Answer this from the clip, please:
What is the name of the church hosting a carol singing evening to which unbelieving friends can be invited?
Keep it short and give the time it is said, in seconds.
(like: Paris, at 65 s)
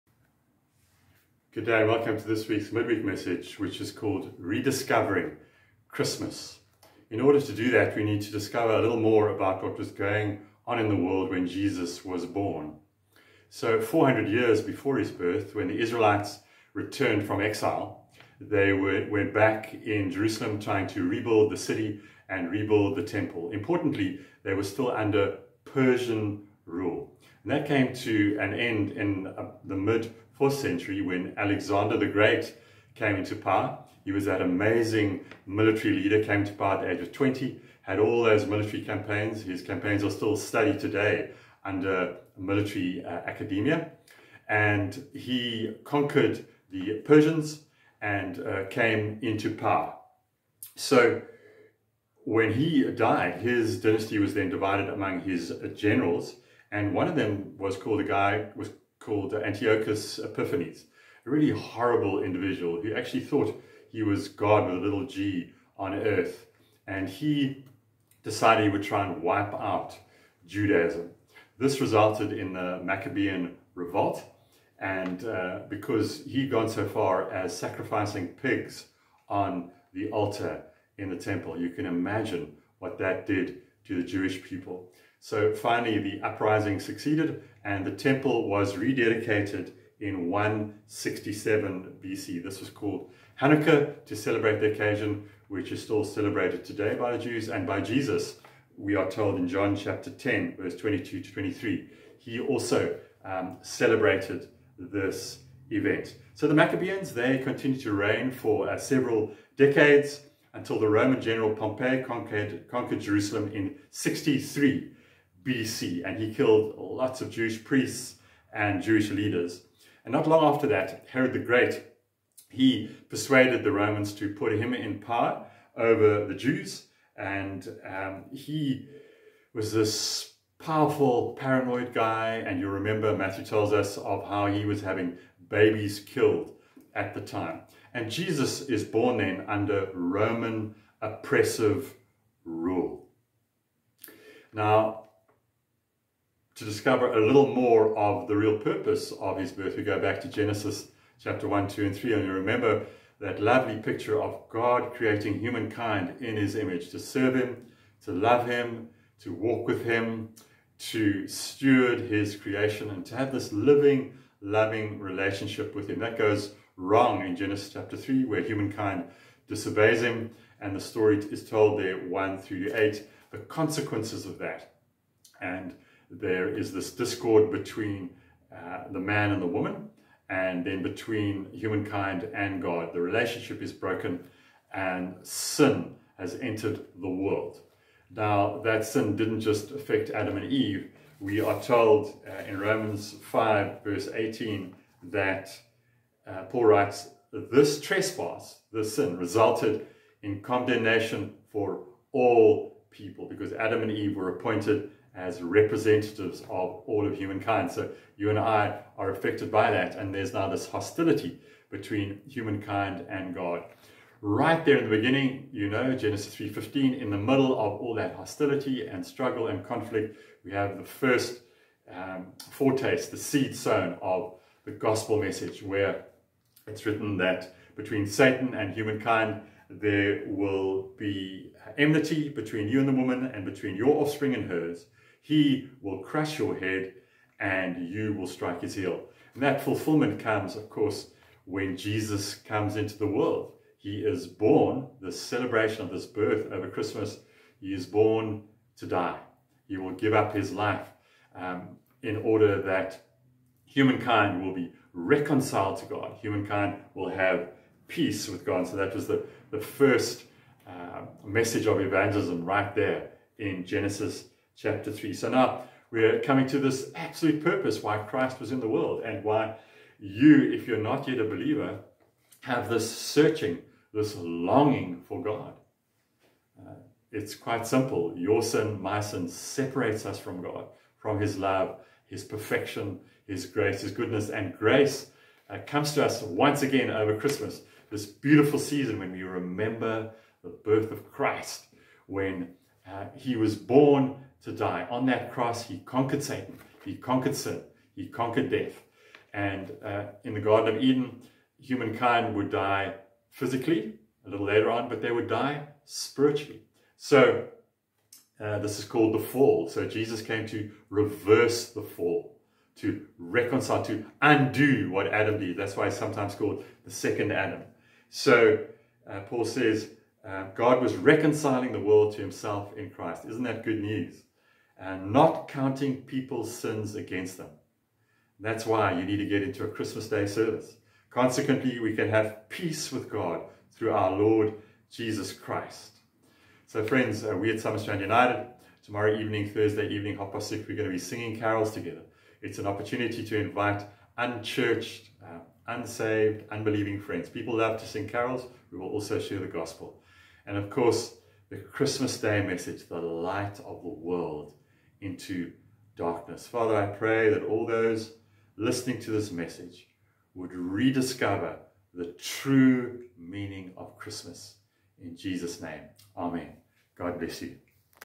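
Summerstrand United, at 337 s.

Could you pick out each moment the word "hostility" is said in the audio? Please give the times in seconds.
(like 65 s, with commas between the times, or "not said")
210 s, 218 s.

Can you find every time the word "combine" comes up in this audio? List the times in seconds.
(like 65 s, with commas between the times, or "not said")
not said.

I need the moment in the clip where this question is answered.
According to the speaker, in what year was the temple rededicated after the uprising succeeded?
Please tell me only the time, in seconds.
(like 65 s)
90 s.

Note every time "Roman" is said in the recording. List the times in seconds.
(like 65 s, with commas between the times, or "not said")
110 s, 123 s, 139 s, 192 s.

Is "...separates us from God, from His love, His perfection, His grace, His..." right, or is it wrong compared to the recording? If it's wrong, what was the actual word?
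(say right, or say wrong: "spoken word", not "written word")
right.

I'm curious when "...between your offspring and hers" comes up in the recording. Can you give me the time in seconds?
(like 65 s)
233 s.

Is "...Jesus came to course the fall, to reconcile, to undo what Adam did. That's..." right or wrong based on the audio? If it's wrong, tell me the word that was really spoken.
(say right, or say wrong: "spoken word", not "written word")
wrong: "reverse", not "course".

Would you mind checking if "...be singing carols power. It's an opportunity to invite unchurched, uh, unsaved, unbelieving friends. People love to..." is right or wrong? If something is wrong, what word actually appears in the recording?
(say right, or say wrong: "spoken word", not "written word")
wrong: "together", not "power".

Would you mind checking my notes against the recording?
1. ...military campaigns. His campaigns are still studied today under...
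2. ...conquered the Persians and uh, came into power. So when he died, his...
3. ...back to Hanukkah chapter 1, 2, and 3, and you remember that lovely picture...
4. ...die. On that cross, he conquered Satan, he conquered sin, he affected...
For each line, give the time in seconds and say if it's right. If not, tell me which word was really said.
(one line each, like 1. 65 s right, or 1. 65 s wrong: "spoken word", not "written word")
1. 38 s right
2. 45 s right
3. 149 s wrong: "Genesis", not "Hanukkah"
4. 294 s wrong: "conquered", not "affected".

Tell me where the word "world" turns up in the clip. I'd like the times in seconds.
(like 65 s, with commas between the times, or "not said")
10 s, 187 s, 243 s, 268 s, 321 s, 353 s.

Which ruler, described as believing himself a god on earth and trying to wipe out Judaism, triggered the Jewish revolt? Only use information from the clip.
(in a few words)
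Antiochus Epiphanes.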